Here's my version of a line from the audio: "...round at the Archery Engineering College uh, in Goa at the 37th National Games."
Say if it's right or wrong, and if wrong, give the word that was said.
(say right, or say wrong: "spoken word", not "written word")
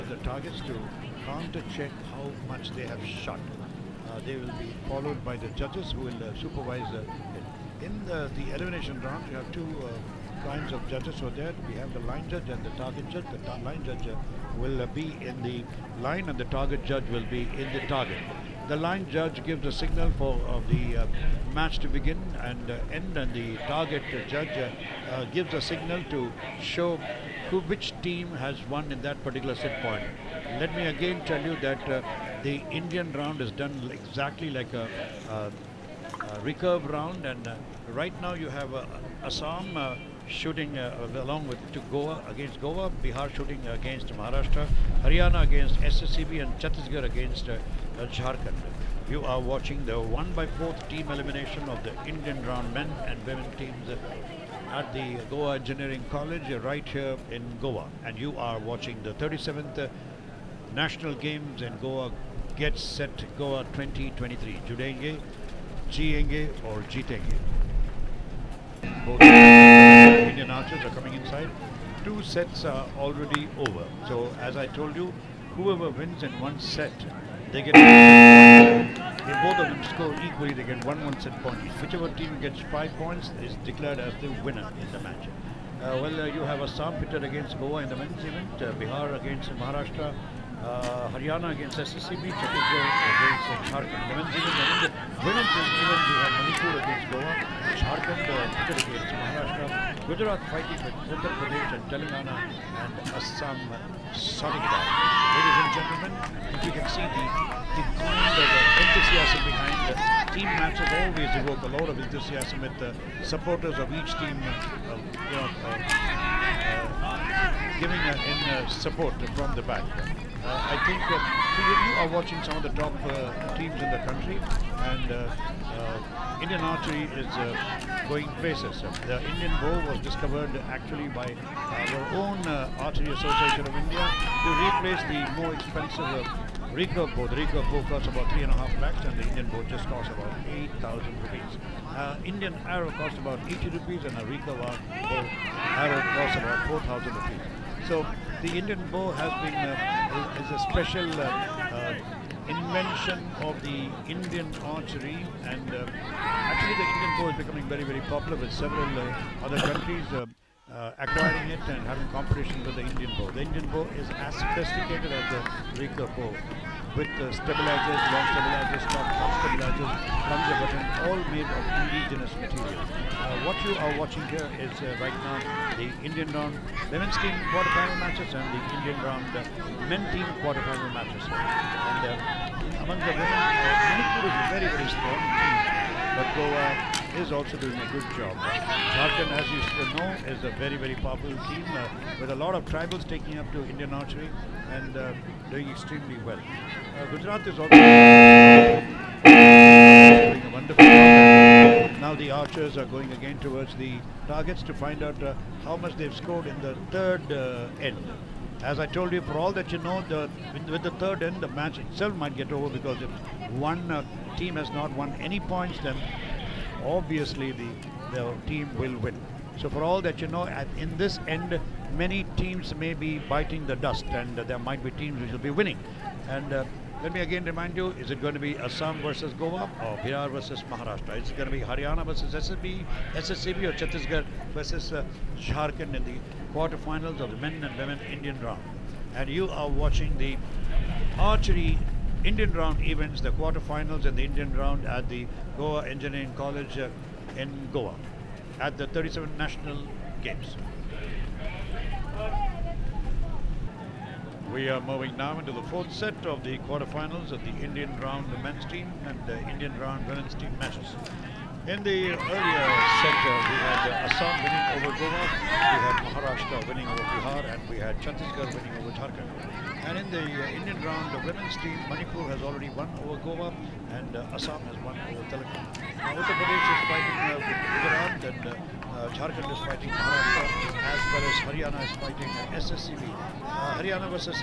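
wrong: "Goa", not "Archery".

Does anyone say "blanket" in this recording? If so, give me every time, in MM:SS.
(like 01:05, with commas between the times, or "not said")
not said.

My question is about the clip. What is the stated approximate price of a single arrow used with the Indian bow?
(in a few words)
80 rupees.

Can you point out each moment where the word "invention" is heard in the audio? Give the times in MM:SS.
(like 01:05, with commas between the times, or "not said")
02:32.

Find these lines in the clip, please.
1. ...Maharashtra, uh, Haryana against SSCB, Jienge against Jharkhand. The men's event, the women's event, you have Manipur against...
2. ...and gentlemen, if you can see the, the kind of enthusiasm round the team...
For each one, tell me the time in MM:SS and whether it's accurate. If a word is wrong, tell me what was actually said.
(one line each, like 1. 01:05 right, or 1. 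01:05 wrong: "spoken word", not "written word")
1. 01:29 wrong: "Chhattisgarh", not "Jienge"
2. 01:45 wrong: "behind", not "round".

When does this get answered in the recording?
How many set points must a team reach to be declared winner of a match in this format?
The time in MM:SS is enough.
01:22.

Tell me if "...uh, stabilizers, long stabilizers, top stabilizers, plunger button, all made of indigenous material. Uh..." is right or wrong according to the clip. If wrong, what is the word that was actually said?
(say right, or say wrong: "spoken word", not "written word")
right.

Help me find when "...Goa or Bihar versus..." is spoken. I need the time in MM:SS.
03:49.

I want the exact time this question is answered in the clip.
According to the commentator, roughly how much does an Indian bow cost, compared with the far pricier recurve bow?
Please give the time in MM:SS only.
02:20.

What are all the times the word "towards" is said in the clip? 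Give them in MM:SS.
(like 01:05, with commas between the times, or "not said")
03:23.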